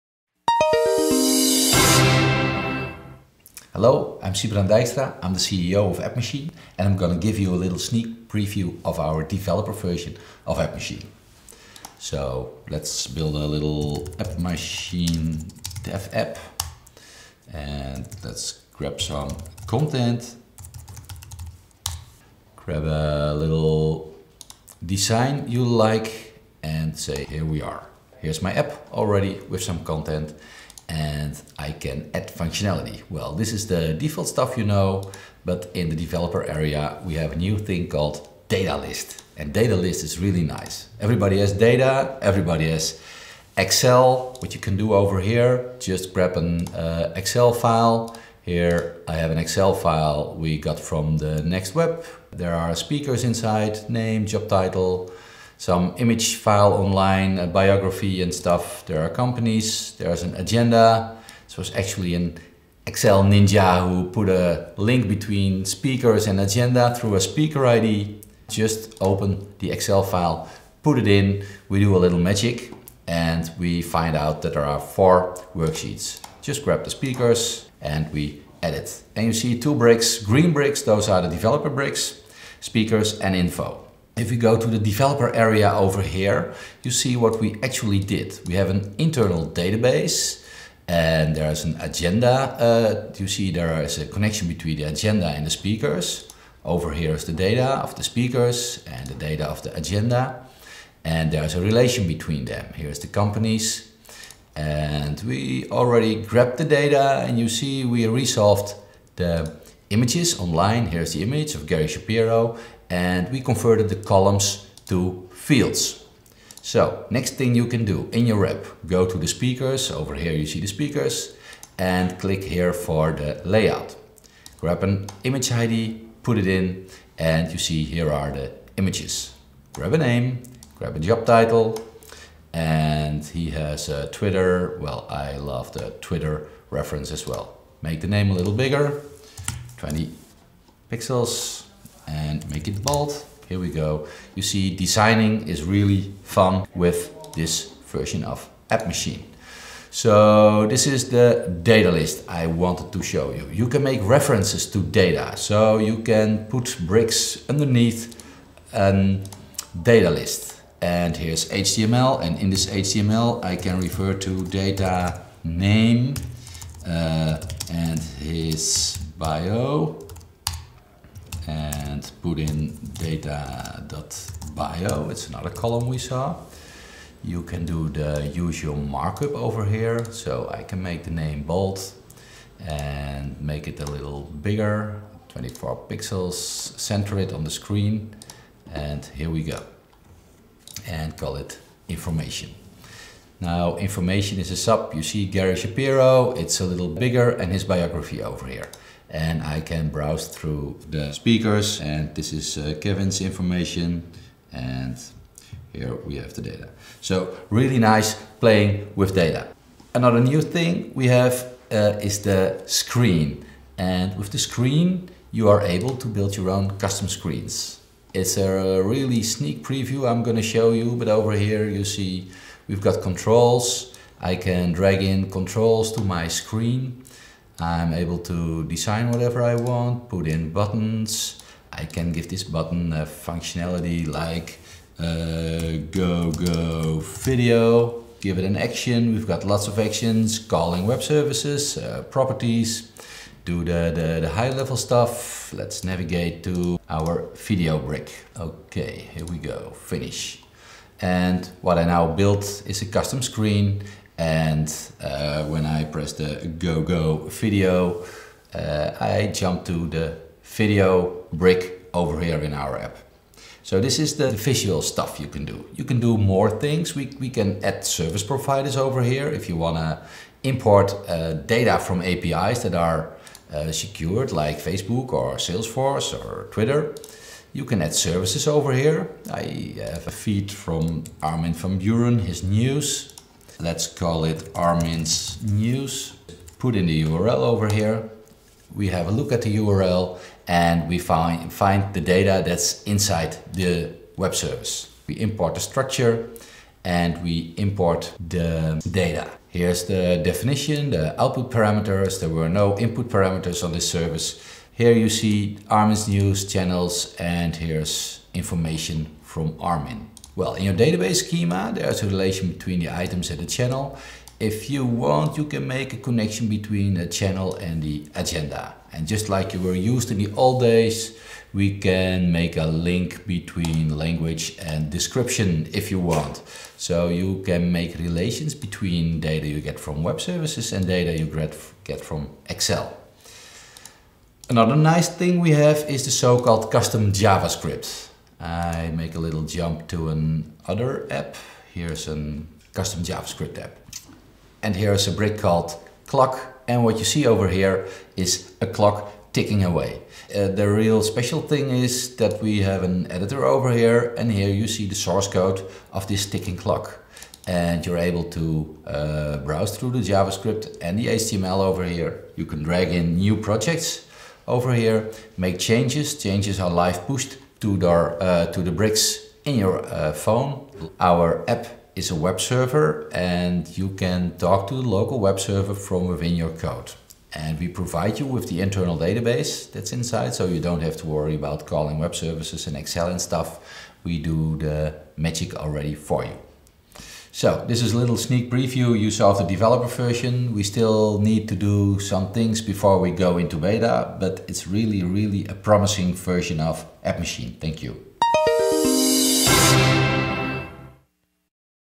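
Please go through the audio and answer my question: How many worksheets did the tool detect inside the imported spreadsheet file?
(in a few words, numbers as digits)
4.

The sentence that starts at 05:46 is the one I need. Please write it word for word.
And what you see over here is a clock ticking away.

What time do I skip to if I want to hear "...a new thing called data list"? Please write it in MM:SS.
00:37.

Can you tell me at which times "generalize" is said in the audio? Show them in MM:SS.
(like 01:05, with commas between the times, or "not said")
not said.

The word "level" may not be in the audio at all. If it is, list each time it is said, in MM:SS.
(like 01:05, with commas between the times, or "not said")
04:04.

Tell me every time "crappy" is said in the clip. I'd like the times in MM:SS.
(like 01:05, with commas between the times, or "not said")
not said.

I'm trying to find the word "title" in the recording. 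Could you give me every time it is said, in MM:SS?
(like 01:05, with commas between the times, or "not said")
00:54, 02:11.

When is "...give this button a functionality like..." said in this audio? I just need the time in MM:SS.
03:52.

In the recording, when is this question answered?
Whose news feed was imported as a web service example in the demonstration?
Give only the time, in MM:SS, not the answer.
04:41.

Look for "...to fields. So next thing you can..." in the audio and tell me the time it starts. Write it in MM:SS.
01:54.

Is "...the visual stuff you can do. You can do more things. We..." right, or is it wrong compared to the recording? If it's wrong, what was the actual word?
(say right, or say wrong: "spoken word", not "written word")
right.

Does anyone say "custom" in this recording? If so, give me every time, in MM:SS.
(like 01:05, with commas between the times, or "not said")
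03:36, 04:12, 05:36, 05:42.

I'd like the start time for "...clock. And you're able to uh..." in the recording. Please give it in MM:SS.
05:56.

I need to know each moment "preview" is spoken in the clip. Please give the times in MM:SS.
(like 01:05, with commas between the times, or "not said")
00:08, 03:39, 06:28.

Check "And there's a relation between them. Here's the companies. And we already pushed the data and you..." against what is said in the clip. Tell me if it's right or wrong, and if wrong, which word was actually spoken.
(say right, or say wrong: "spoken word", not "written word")
wrong: "grabbed", not "pushed".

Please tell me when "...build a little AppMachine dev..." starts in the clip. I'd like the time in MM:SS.
00:13.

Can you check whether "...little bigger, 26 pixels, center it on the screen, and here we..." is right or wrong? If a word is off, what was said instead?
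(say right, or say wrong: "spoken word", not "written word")
wrong: "24", not "26".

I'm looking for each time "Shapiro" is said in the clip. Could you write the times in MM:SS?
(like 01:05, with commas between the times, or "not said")
01:51, 03:15.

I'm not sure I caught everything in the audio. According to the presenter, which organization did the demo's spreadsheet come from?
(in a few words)
The Next Web.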